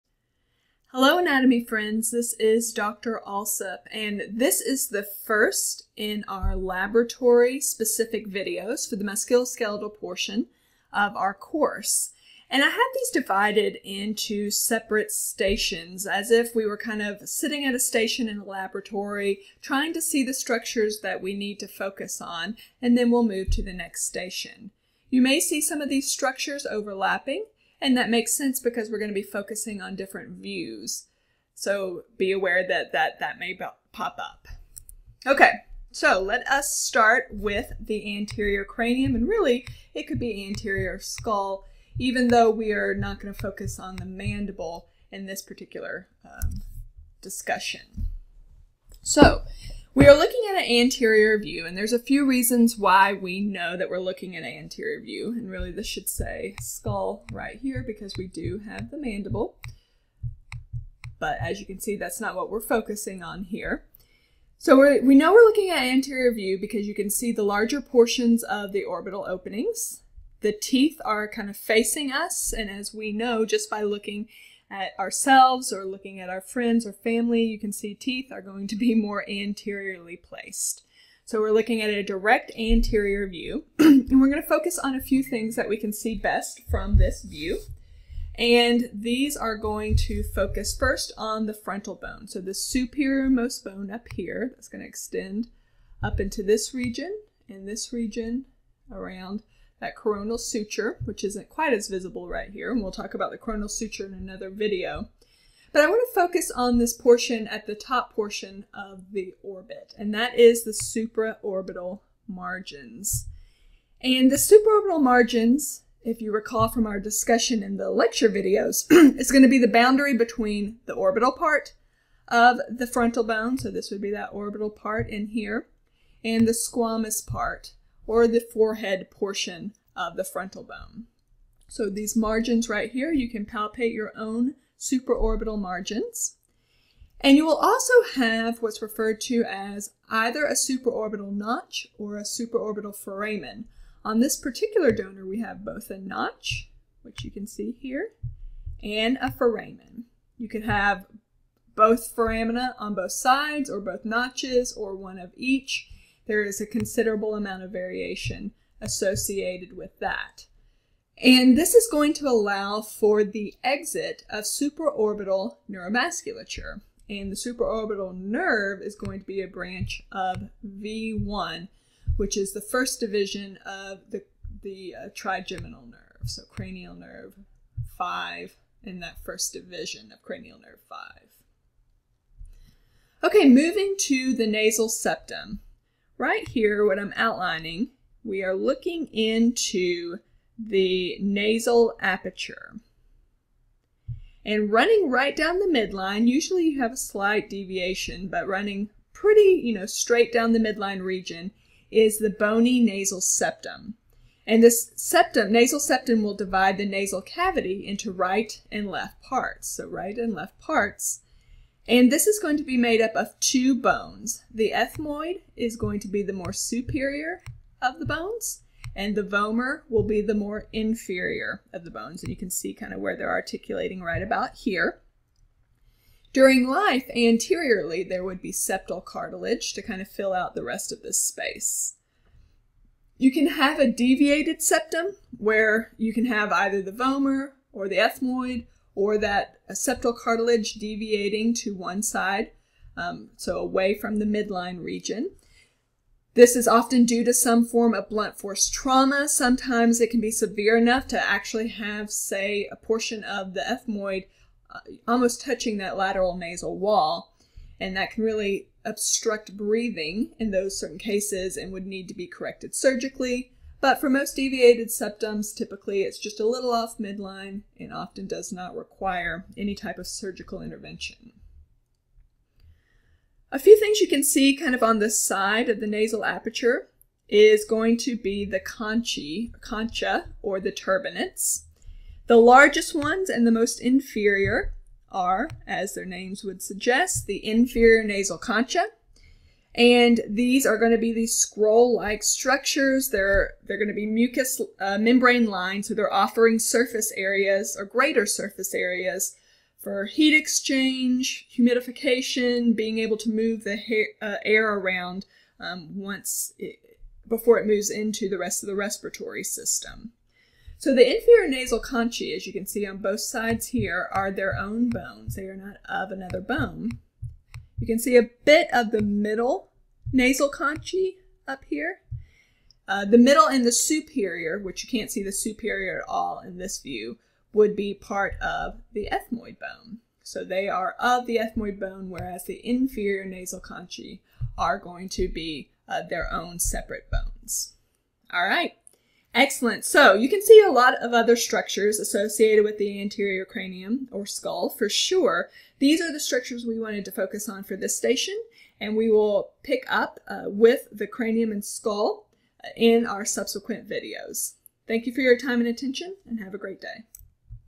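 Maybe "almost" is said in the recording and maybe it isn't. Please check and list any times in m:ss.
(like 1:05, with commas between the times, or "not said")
4:15.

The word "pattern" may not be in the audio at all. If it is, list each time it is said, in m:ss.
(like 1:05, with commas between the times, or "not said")
not said.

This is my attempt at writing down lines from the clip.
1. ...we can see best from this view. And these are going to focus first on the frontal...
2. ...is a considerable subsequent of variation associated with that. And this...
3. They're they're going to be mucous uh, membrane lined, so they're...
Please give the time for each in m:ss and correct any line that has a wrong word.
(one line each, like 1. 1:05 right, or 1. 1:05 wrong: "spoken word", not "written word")
1. 1:25 right
2. 2:36 wrong: "amount", not "subsequent"
3. 4:53 right.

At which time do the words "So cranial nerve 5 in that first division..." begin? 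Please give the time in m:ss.
2:56.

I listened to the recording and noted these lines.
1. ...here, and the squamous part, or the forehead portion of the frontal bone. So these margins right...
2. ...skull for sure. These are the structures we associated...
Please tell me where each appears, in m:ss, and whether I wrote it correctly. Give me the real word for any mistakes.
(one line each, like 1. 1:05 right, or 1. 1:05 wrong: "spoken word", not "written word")
1. 2:05 right
2. 5:44 wrong: "wanted", not "associated".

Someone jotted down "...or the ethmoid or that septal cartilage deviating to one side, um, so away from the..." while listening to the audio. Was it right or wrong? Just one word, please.
right.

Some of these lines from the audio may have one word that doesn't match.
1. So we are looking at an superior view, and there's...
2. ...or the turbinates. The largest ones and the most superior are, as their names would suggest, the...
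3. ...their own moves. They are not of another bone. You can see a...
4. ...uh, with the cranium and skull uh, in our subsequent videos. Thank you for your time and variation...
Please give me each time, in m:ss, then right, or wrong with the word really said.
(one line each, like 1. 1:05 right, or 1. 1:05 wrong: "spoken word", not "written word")
1. 0:49 wrong: "anterior", not "superior"
2. 4:40 wrong: "inferior", not "superior"
3. 5:14 wrong: "bones", not "moves"
4. 5:50 wrong: "attention", not "variation".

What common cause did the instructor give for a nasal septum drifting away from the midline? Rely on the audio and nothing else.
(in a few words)
Blunt force trauma.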